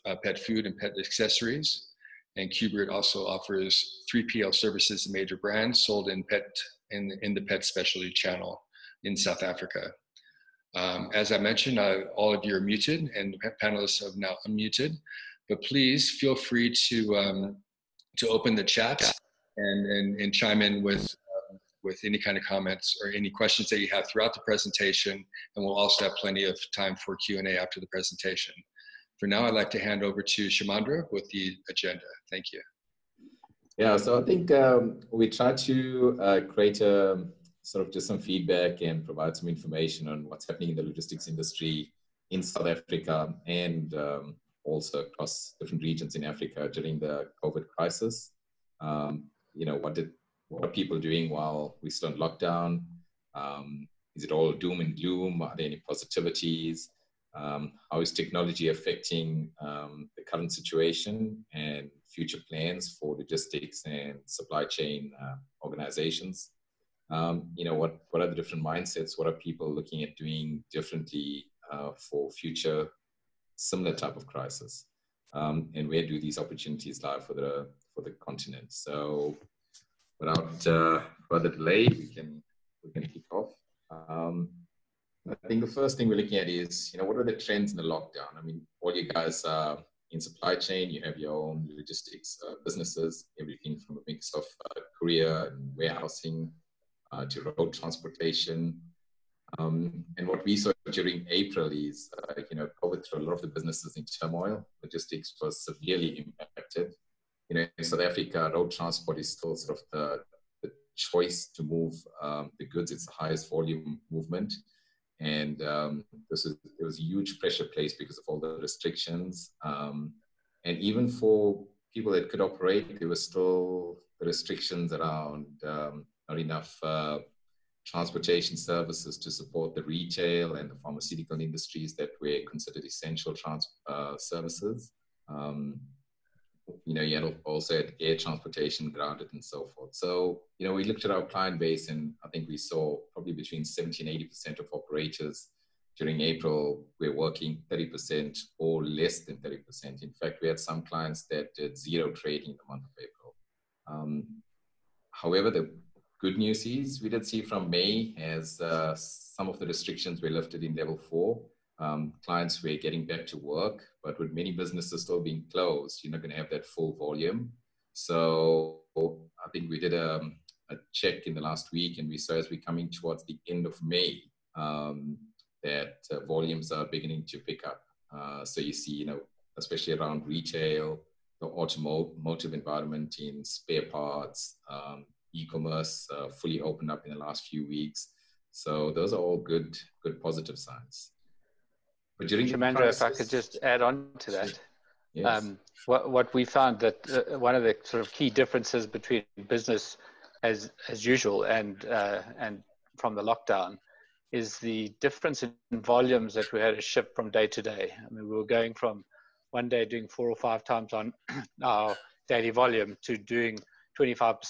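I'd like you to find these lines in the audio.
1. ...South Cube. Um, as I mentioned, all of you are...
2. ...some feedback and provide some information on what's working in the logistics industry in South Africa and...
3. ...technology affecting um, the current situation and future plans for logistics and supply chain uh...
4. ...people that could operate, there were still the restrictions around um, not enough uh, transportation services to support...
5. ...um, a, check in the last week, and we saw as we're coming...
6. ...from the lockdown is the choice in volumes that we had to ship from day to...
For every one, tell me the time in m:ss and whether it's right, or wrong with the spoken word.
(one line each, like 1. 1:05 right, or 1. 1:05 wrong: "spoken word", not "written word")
1. 0:09 wrong: "Africa", not "Cube"
2. 0:38 wrong: "happening", not "working"
3. 0:58 right
4. 2:01 right
5. 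2:50 right
6. 3:22 wrong: "difference", not "choice".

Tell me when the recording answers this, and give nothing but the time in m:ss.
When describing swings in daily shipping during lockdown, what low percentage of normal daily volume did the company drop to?
3:33.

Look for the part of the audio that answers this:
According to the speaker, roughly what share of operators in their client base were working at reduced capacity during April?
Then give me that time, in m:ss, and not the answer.
2:23.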